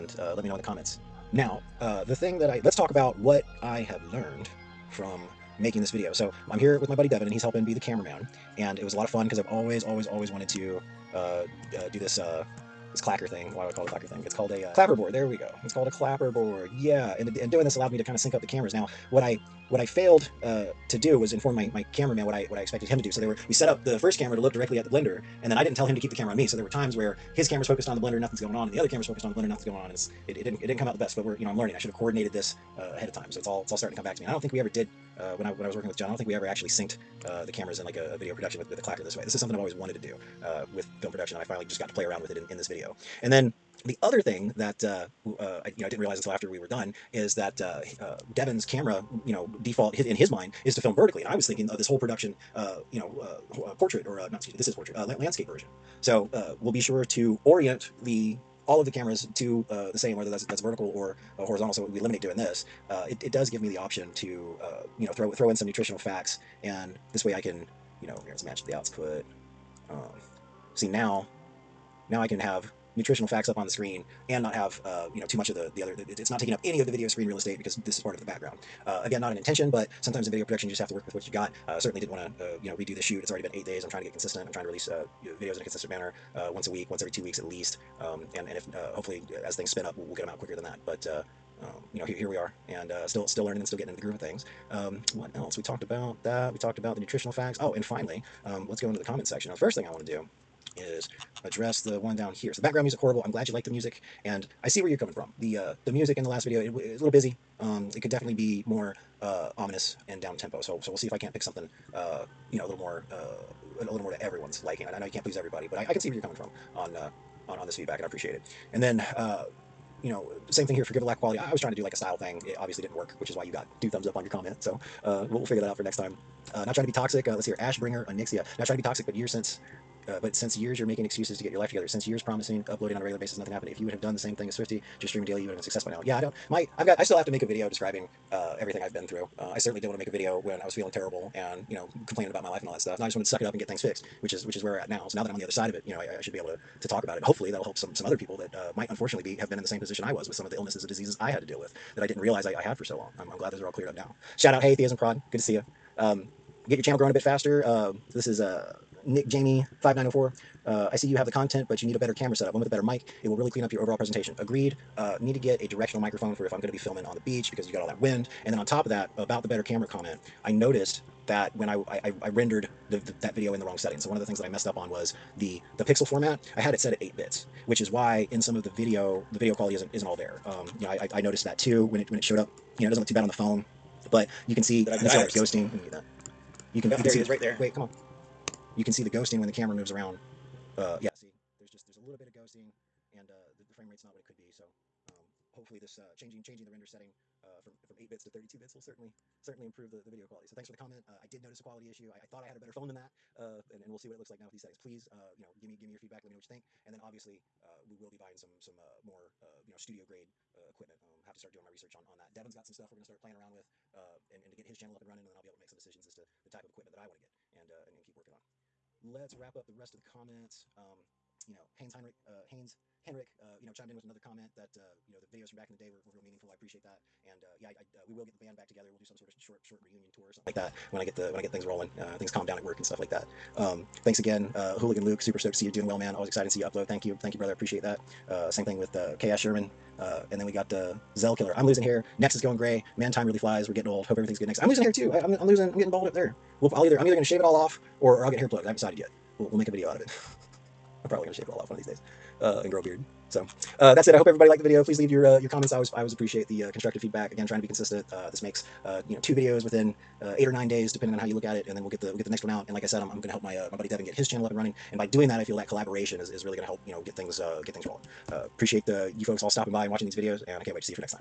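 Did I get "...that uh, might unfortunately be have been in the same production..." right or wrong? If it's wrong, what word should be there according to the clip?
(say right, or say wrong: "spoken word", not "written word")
wrong: "position", not "production".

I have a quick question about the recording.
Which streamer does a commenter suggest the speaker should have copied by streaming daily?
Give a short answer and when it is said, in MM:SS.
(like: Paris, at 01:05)
Swifty, at 02:14.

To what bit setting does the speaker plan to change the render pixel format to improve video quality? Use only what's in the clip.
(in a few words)
32 bits.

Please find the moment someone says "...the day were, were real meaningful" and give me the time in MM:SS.
03:45.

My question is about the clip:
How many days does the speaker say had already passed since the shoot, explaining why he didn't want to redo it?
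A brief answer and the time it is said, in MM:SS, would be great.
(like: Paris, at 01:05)
8, at 01:23.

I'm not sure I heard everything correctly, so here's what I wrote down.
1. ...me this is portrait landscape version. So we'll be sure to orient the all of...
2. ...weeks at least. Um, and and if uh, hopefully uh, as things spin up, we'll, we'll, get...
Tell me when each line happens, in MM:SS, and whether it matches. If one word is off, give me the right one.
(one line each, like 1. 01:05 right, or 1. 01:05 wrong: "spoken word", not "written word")
1. 00:54 right
2. 01:27 right.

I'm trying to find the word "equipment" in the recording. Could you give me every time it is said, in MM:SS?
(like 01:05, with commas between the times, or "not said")
03:30, 03:36.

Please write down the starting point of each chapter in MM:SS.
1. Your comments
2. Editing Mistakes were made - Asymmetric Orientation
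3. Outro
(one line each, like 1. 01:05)
1. 01:39
2. 00:43
3. 04:13.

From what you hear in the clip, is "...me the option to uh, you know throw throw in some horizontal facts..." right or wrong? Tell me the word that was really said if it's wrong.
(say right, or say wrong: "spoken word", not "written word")
wrong: "nutritional", not "horizontal".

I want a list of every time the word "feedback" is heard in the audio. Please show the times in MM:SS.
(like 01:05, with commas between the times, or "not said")
01:57, 03:25, 04:17.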